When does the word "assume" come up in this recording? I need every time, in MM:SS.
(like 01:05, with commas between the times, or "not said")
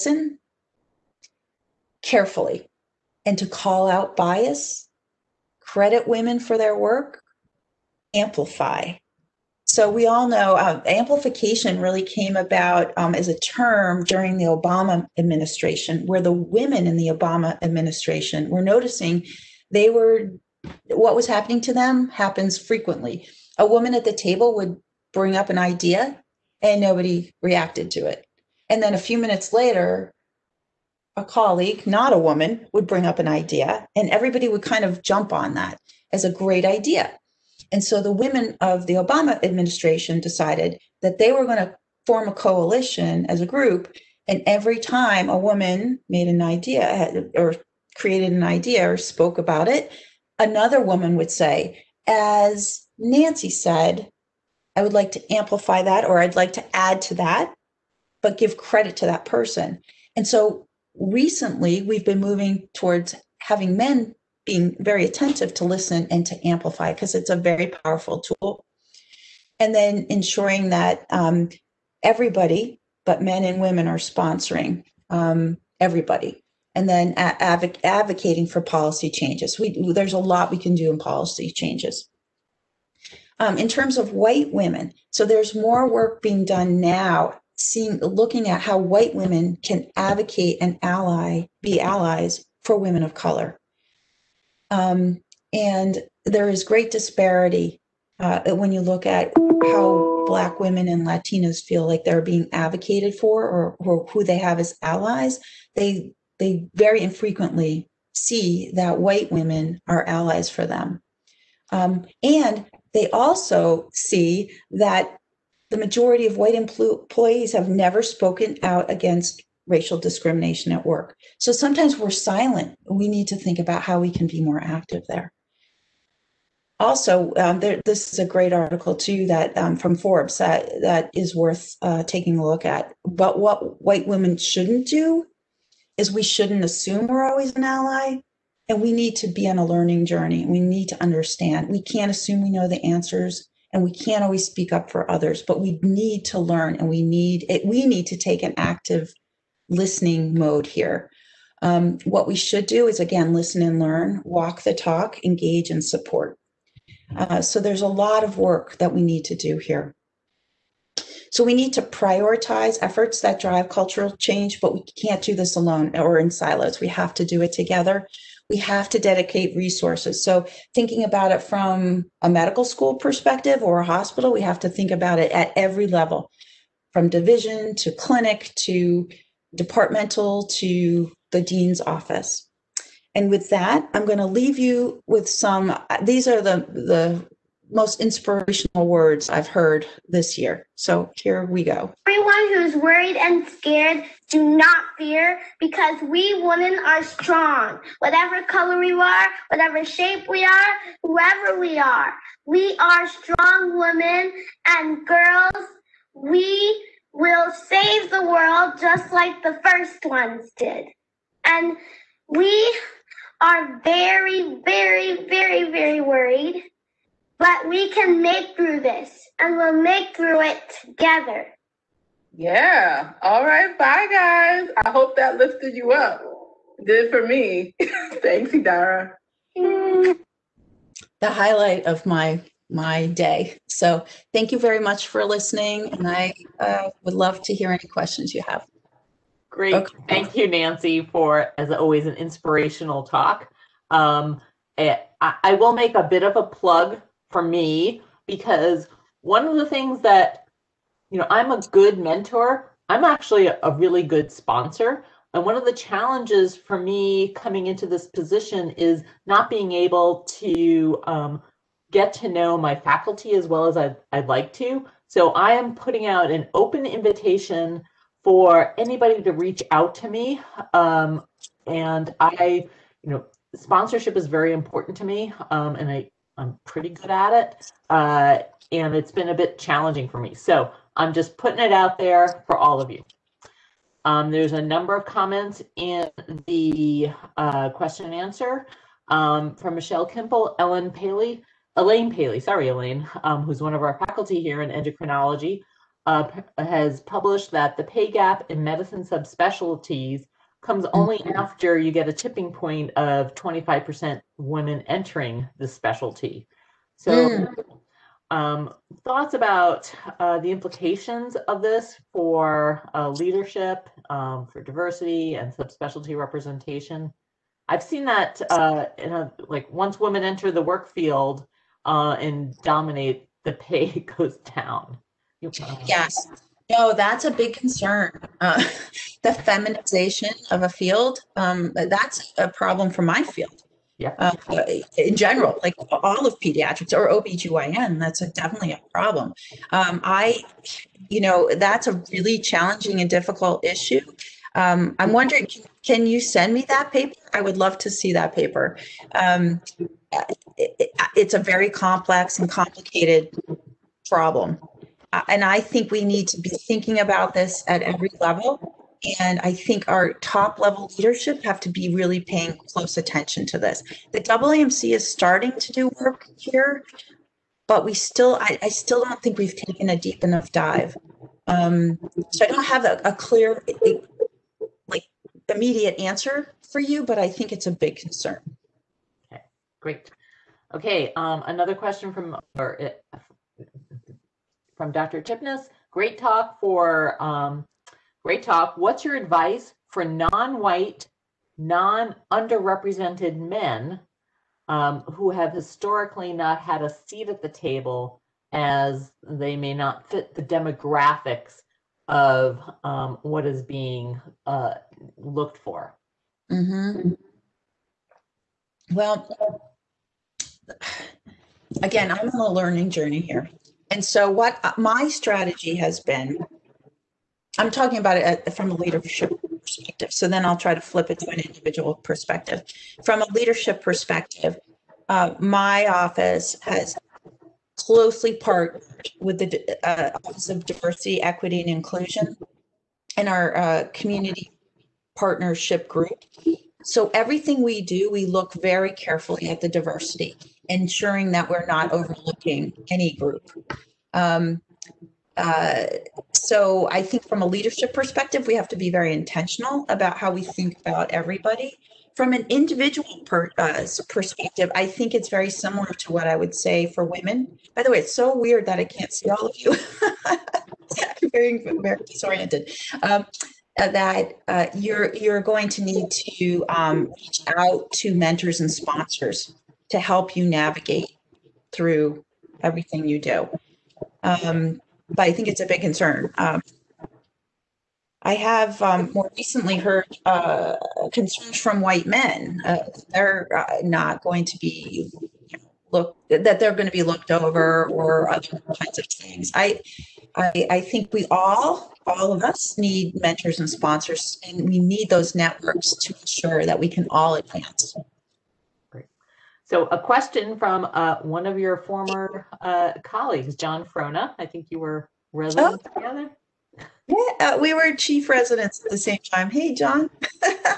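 02:16, 02:22.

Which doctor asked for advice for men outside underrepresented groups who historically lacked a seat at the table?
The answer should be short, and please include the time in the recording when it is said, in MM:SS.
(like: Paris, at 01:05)
Dr. Chipness, at 06:24.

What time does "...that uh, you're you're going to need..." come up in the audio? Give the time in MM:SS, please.
07:43.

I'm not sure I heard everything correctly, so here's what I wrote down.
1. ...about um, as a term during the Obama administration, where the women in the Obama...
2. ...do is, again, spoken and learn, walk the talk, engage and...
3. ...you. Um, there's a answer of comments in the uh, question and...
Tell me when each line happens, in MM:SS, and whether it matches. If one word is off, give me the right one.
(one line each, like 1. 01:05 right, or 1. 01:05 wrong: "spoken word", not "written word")
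1. 00:12 right
2. 02:32 wrong: "listen", not "spoken"
3. 04:42 wrong: "number", not "answer".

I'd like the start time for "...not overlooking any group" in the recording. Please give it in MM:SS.
07:21.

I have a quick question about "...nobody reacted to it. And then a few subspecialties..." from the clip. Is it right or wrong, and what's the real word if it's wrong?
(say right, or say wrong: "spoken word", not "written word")
wrong: "minutes", not "subspecialties".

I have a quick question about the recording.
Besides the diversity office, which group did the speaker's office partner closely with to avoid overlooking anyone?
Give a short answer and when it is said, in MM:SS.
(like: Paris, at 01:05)
community partnership group, at 07:13.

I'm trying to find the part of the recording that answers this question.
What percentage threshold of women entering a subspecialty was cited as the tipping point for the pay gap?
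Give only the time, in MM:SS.
05:03.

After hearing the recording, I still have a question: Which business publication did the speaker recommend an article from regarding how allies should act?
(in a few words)
Forbes.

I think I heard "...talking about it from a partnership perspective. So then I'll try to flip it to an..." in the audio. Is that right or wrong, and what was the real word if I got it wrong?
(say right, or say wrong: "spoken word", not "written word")
wrong: "leadership", not "partnership".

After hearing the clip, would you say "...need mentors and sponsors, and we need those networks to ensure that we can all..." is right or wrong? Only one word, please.
right.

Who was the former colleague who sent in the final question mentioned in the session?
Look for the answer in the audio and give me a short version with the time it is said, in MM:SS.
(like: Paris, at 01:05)
John Frohna, at 08:23.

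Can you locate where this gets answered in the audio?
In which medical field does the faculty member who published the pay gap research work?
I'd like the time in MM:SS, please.
04:54.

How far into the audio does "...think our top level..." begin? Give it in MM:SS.
05:59.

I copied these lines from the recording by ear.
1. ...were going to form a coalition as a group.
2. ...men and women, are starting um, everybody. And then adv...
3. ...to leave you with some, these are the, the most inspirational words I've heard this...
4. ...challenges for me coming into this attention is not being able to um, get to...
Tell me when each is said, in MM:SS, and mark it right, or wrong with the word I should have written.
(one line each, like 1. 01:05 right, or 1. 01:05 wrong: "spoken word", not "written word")
1. 00:41 right
2. 01:13 wrong: "sponsoring", not "starting"
3. 03:04 right
4. 04:15 wrong: "position", not "attention".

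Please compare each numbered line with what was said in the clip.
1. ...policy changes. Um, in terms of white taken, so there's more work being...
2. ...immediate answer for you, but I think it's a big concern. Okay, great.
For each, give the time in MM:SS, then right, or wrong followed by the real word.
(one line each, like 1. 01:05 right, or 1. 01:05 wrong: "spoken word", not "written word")
1. 01:20 wrong: "women", not "taken"
2. 06:15 right.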